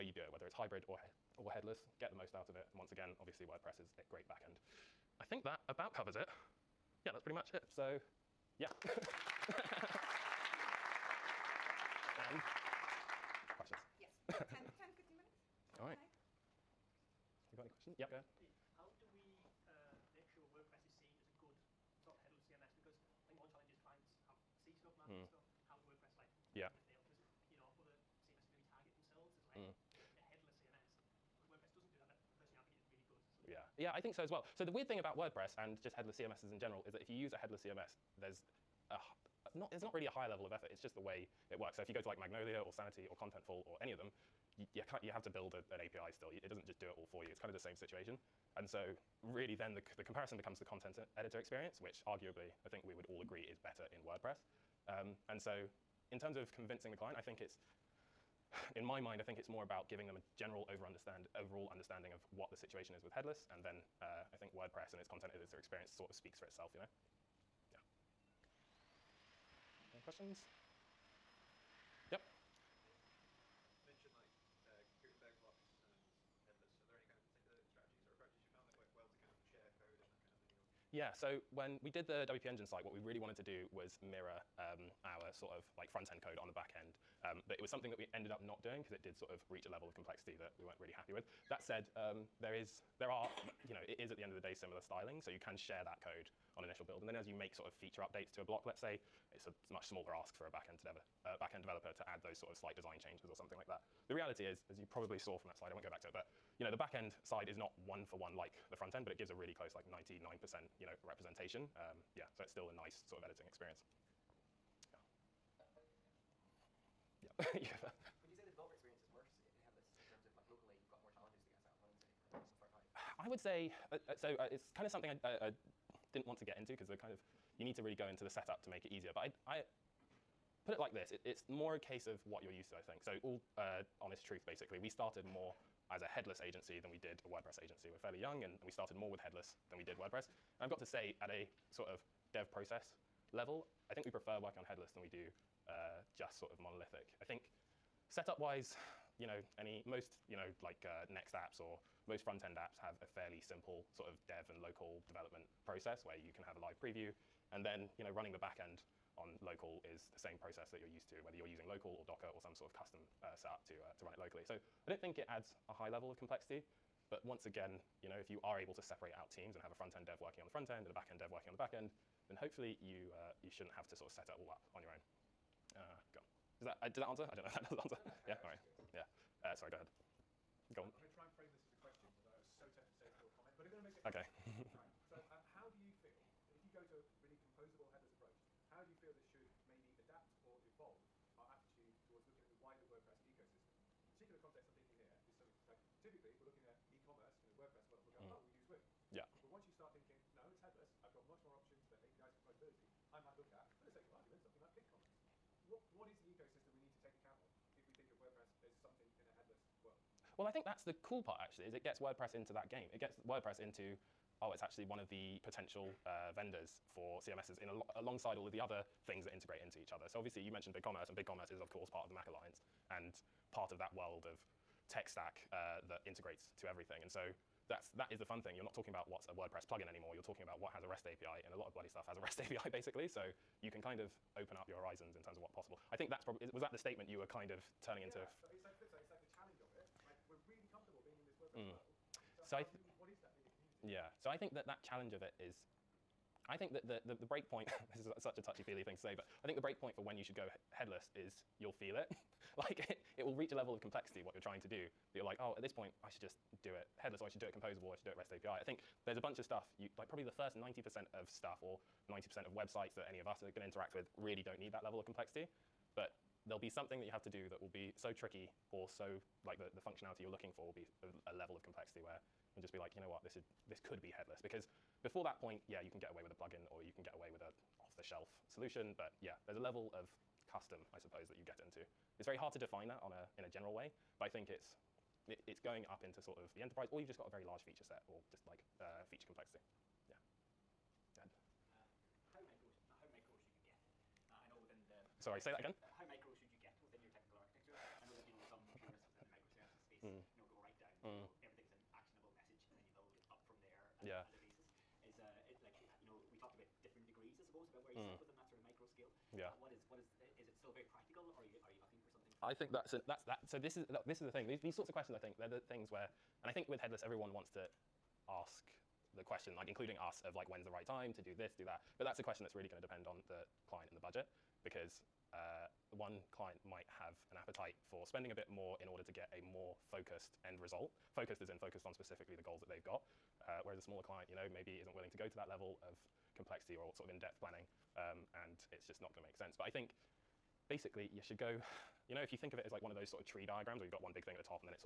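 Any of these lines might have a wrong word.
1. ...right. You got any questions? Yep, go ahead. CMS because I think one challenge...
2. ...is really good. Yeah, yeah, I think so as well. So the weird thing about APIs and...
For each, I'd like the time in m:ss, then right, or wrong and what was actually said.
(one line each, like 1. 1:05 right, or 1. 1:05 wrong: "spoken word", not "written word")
1. 0:15 right
2. 0:32 wrong: "WordPress", not "APIs".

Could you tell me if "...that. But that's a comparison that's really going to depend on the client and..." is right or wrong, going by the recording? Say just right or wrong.
wrong.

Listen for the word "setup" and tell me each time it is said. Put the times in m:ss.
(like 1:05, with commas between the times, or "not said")
2:08, 2:28, 2:43.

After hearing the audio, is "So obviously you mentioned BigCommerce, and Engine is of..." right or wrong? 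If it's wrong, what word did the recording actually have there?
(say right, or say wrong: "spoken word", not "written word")
wrong: "BigCommerce", not "Engine".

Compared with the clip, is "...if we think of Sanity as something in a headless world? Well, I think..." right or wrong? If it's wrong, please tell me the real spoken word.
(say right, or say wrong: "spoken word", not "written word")
wrong: "WordPress", not "Sanity".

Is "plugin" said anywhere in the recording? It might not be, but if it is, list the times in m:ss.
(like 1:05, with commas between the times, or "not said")
3:49, 4:36.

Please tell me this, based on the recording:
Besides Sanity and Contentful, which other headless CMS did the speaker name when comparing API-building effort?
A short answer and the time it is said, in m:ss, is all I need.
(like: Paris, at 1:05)
Magnolia, at 0:42.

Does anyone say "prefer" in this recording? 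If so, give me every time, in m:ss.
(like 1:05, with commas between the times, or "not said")
2:24.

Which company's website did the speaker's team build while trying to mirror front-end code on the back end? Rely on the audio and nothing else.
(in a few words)
WP Engine.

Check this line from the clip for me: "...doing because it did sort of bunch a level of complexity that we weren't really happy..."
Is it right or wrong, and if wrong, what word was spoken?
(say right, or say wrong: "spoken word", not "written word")
wrong: "reach", not "bunch".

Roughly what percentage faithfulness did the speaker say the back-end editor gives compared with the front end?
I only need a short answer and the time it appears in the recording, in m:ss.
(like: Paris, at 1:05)
99%, at 1:49.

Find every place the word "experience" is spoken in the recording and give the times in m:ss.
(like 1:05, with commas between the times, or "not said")
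0:51, 1:05, 1:53, 1:58.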